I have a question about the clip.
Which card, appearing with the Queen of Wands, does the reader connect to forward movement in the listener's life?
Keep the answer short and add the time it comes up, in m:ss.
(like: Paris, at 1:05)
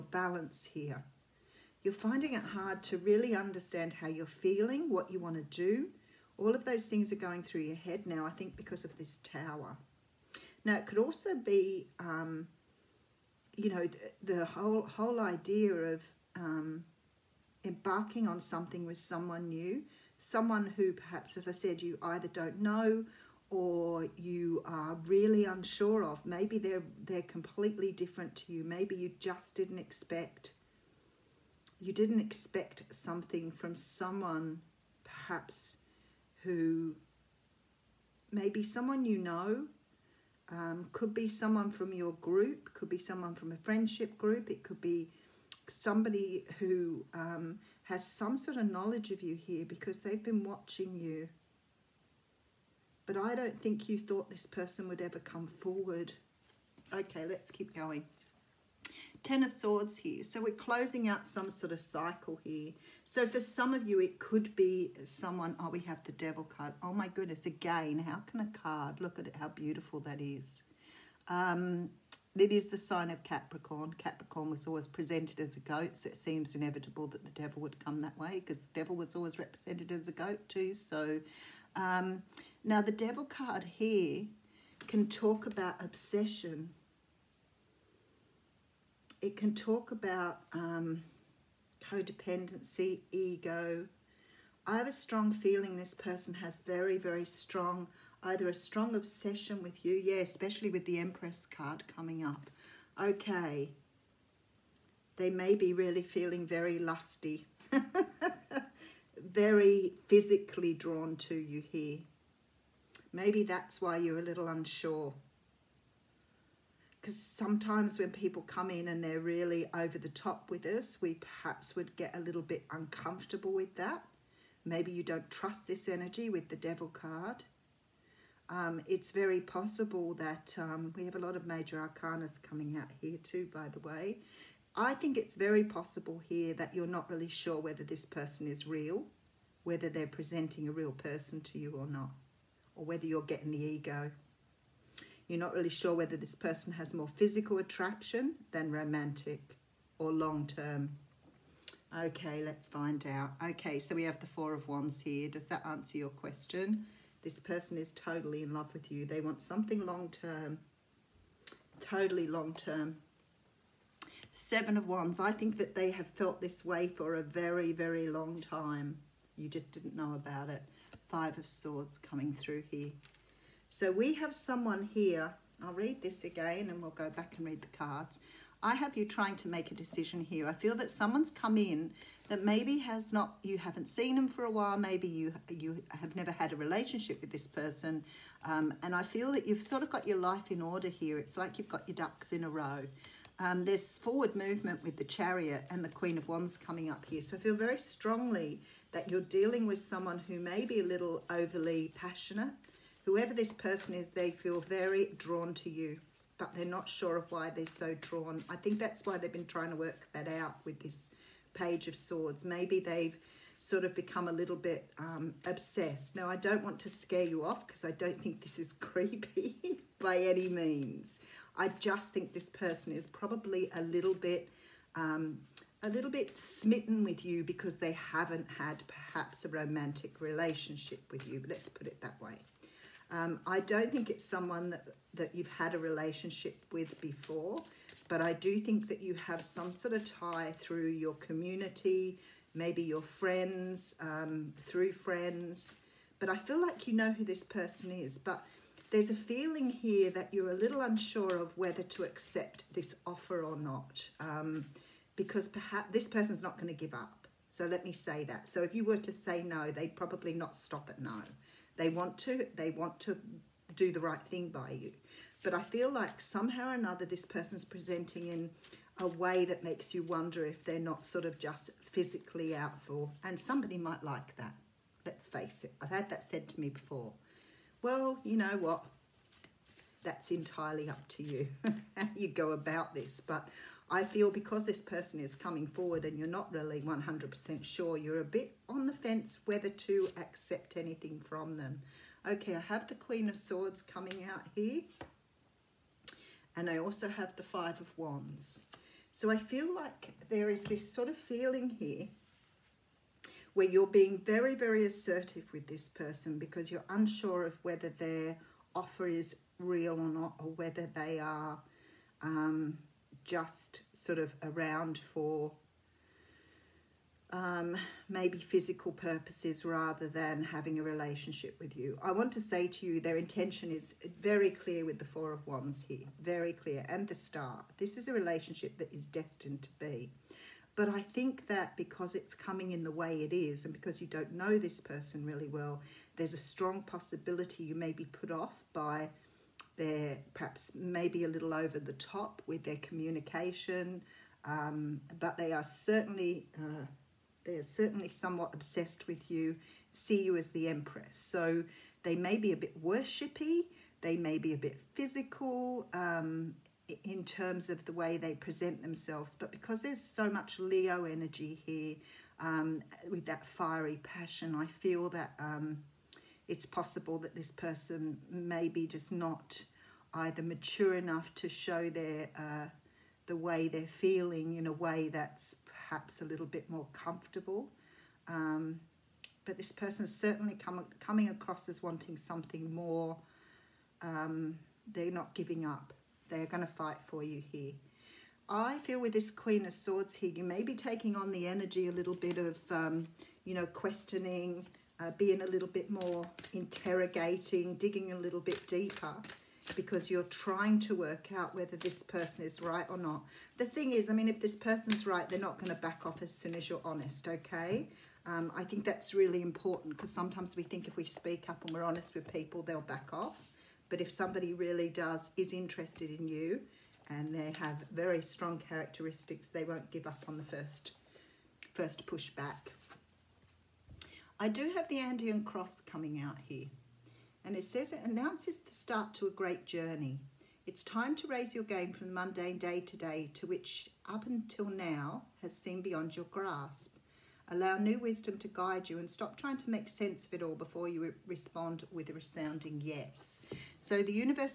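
The Chariot, at 3:15.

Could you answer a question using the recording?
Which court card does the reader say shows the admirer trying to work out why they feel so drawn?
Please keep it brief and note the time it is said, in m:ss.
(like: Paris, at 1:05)
Page of Swords, at 3:31.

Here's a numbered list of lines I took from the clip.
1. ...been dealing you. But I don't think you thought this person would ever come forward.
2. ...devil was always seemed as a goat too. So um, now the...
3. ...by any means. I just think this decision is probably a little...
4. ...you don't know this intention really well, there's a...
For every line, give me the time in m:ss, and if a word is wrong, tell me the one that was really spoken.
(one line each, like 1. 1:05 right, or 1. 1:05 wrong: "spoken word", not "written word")
1. 0:50 wrong: "watching", not "dealing"
2. 1:18 wrong: "represented", not "seemed"
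3. 3:39 wrong: "person", not "decision"
4. 5:34 wrong: "person", not "intention".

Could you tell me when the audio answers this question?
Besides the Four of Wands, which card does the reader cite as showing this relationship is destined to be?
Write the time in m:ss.
5:27.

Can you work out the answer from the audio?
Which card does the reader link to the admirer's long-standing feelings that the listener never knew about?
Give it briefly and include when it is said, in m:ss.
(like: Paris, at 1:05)
Seven of Wands, at 2:44.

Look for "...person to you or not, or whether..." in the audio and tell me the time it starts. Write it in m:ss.
2:20.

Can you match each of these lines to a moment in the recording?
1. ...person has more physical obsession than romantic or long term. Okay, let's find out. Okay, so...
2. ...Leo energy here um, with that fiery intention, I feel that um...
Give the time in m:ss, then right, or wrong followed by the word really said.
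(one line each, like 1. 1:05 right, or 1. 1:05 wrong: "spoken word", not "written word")
1. 2:26 wrong: "attraction", not "obsession"
2. 6:00 wrong: "passion", not "intention".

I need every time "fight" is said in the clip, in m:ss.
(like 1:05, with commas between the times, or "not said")
6:26.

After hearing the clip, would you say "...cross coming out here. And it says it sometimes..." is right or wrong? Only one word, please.
wrong.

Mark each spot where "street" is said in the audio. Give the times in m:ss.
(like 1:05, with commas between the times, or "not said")
not said.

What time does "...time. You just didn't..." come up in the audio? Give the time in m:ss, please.
2:48.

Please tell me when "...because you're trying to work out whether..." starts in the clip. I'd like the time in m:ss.
6:39.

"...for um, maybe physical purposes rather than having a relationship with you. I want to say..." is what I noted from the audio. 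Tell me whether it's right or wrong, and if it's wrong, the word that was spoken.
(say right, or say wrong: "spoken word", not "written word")
right.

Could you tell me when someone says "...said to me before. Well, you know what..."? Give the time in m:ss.
4:36.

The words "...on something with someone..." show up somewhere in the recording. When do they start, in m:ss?
0:18.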